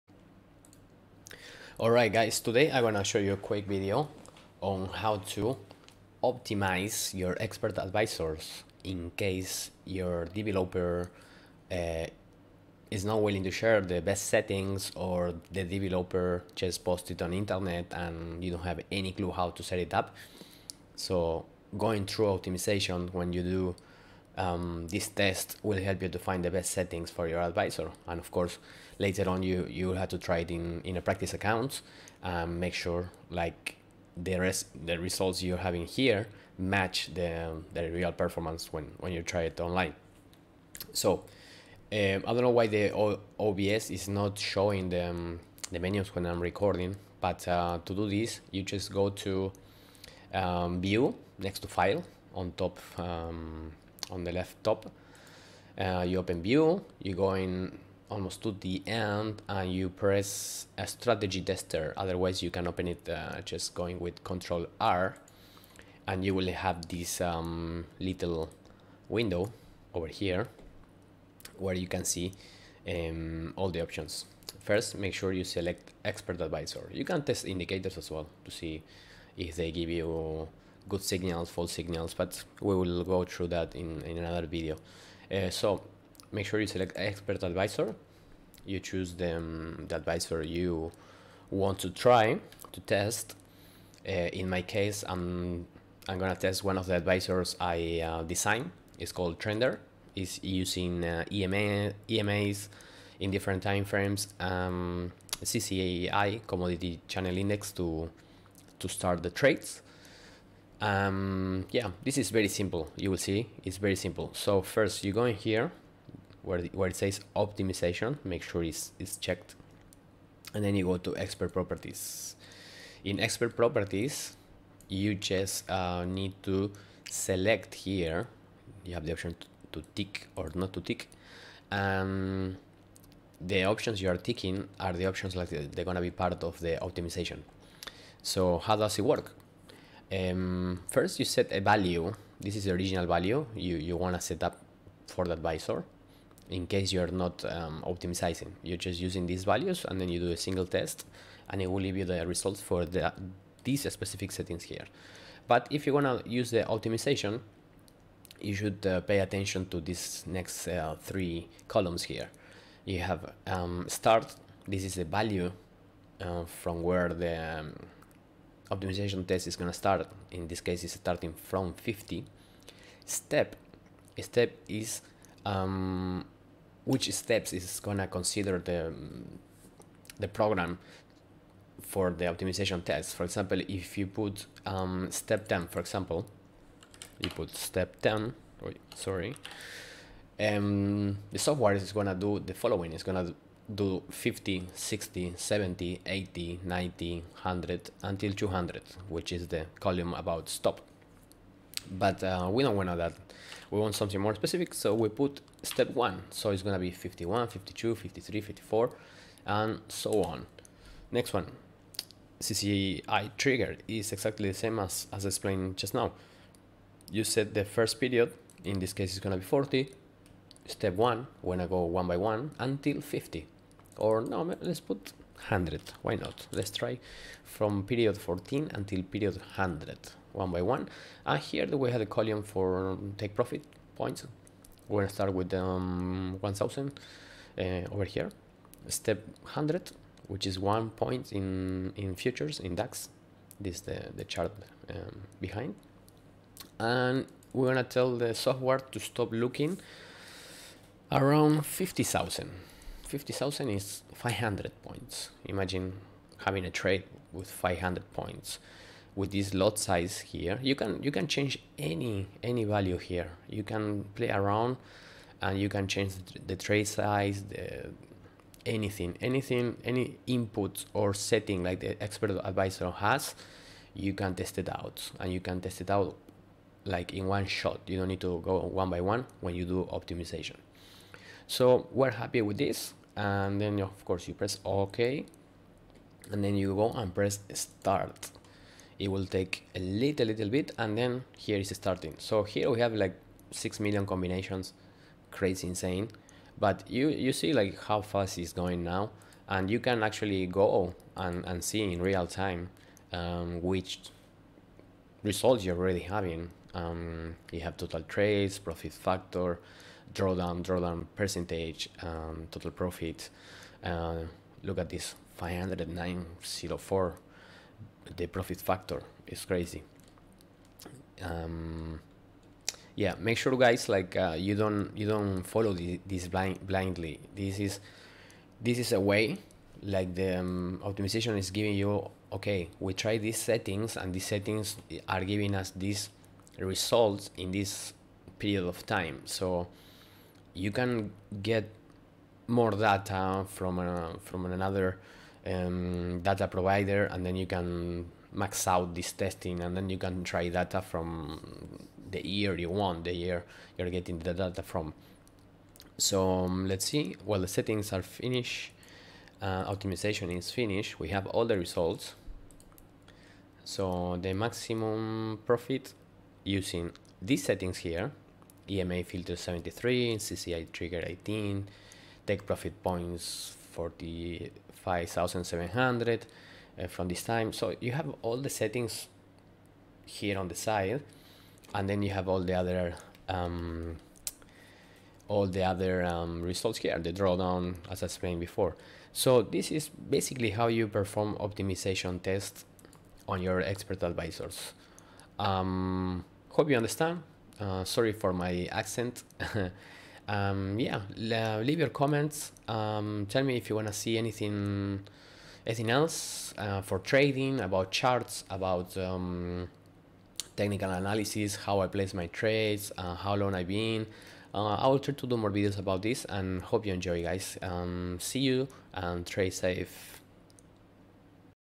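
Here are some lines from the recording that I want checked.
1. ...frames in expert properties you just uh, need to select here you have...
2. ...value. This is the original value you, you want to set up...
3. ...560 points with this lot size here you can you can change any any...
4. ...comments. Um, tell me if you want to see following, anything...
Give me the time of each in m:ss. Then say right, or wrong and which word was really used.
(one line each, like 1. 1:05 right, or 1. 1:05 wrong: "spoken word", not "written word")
1. 2:01 wrong: "properties", not "frames"
2. 2:21 right
3. 4:17 wrong: "500", not "560"
4. 6:41 wrong: "anything", not "following".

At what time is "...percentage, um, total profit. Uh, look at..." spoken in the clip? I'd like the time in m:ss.
5:11.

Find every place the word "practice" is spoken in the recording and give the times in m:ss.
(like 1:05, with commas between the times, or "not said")
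0:31.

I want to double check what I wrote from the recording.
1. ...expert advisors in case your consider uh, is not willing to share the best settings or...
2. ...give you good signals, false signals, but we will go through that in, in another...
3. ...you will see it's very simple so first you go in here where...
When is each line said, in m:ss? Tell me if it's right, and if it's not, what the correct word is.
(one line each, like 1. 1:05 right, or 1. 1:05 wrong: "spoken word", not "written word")
1. 0:07 wrong: "developer", not "consider"
2. 1:19 right
3. 1:52 right.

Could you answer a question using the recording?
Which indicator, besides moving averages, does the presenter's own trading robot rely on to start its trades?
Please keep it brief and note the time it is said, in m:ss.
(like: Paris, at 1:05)
Commodity Channel Index, at 1:46.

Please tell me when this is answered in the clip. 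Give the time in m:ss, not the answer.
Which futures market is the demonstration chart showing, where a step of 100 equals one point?
4:02.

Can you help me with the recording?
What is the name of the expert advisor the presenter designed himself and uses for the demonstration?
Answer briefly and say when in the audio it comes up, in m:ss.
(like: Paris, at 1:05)
Trender, at 1:39.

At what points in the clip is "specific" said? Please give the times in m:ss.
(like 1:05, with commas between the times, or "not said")
2:33, 3:24.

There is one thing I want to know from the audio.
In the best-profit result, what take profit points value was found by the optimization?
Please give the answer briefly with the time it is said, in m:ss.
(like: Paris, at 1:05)
45,700, at 6:13.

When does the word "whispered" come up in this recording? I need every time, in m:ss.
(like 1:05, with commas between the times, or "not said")
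not said.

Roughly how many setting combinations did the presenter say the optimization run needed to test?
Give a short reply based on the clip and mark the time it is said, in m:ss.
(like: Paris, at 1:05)
6 million, at 4:53.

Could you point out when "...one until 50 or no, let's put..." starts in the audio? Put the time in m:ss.
3:42.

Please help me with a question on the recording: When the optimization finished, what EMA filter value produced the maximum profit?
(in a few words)
73.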